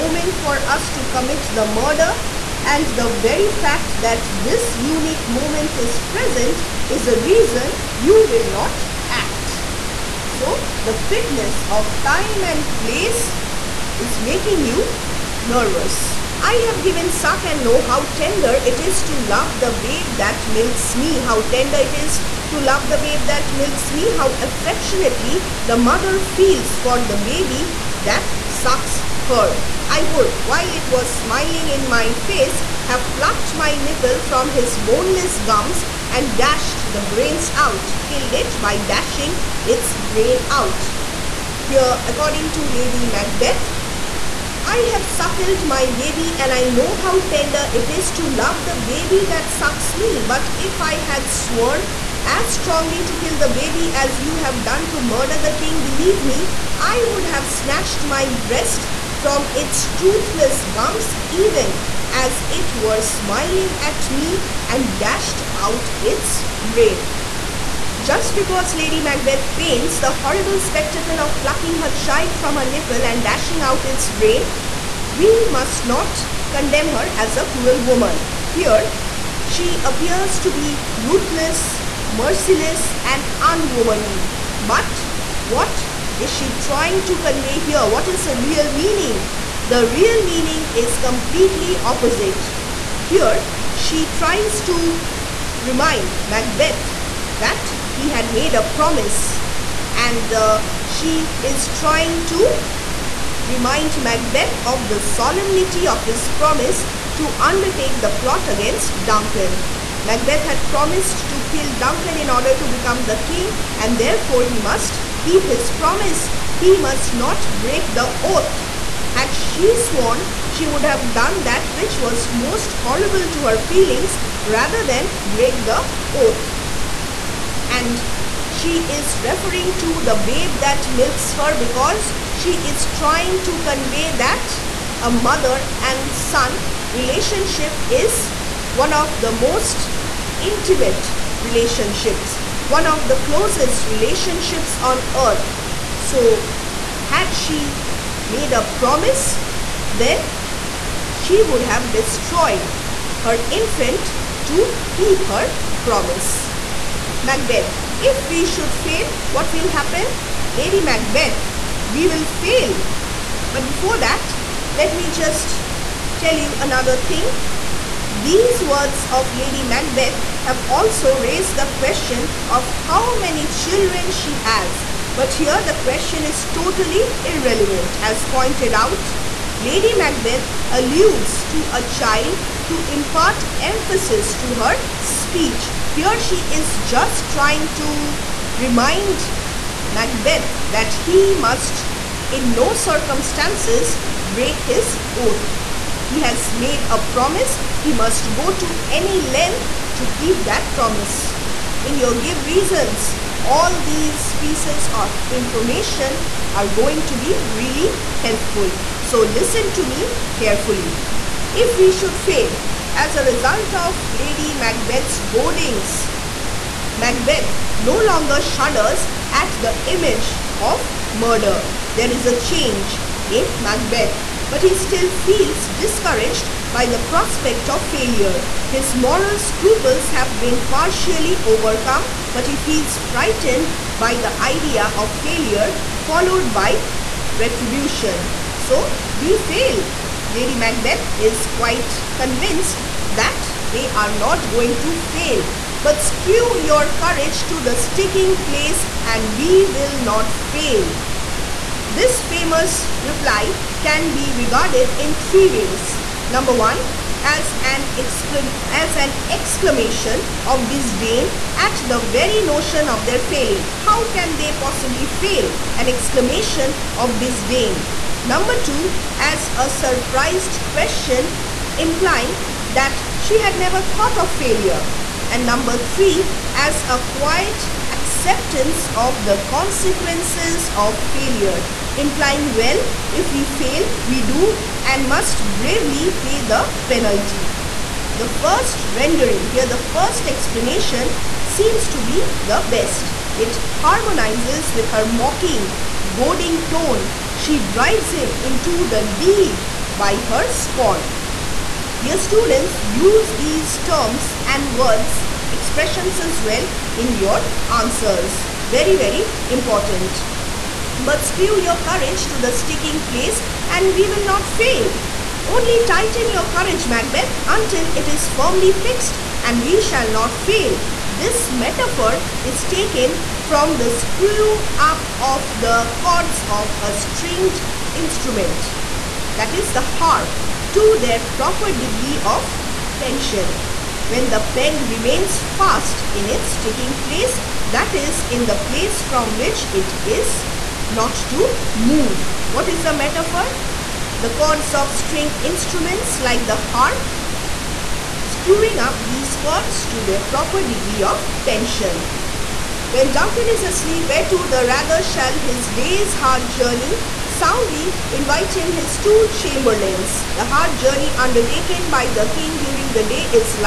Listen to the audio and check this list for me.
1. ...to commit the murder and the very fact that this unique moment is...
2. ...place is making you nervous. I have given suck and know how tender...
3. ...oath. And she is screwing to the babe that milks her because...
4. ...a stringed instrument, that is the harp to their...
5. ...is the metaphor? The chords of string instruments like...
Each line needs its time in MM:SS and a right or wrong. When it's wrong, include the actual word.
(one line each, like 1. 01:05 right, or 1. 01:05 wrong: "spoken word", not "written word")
1. 00:00 right
2. 00:12 right
3. 02:06 wrong: "referring", not "screwing"
4. 05:26 right
5. 05:42 right.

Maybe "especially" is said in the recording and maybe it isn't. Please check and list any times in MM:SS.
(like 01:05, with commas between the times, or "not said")
not said.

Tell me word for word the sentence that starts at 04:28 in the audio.
Number two, as a surprised question implying that she had never thought of failure.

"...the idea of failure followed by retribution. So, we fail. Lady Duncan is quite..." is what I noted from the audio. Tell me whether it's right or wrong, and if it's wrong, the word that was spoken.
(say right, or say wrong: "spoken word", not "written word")
wrong: "Macbeth", not "Duncan".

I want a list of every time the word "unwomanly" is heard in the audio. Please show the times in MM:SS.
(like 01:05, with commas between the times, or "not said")
01:23.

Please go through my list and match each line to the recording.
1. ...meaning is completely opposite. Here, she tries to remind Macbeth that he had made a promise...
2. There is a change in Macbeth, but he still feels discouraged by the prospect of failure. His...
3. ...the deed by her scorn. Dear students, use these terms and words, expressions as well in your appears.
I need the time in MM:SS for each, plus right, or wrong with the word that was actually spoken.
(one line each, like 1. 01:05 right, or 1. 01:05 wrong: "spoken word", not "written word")
1. 01:30 right
2. 03:41 right
3. 04:58 wrong: "answers", not "appears".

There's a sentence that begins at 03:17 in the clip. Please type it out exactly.
He must go to any length to keep that promise.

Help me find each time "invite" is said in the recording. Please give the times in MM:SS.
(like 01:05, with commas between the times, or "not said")
05:58.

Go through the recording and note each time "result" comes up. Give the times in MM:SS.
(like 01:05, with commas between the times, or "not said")
03:33.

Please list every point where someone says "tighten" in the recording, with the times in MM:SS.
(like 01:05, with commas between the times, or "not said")
05:15.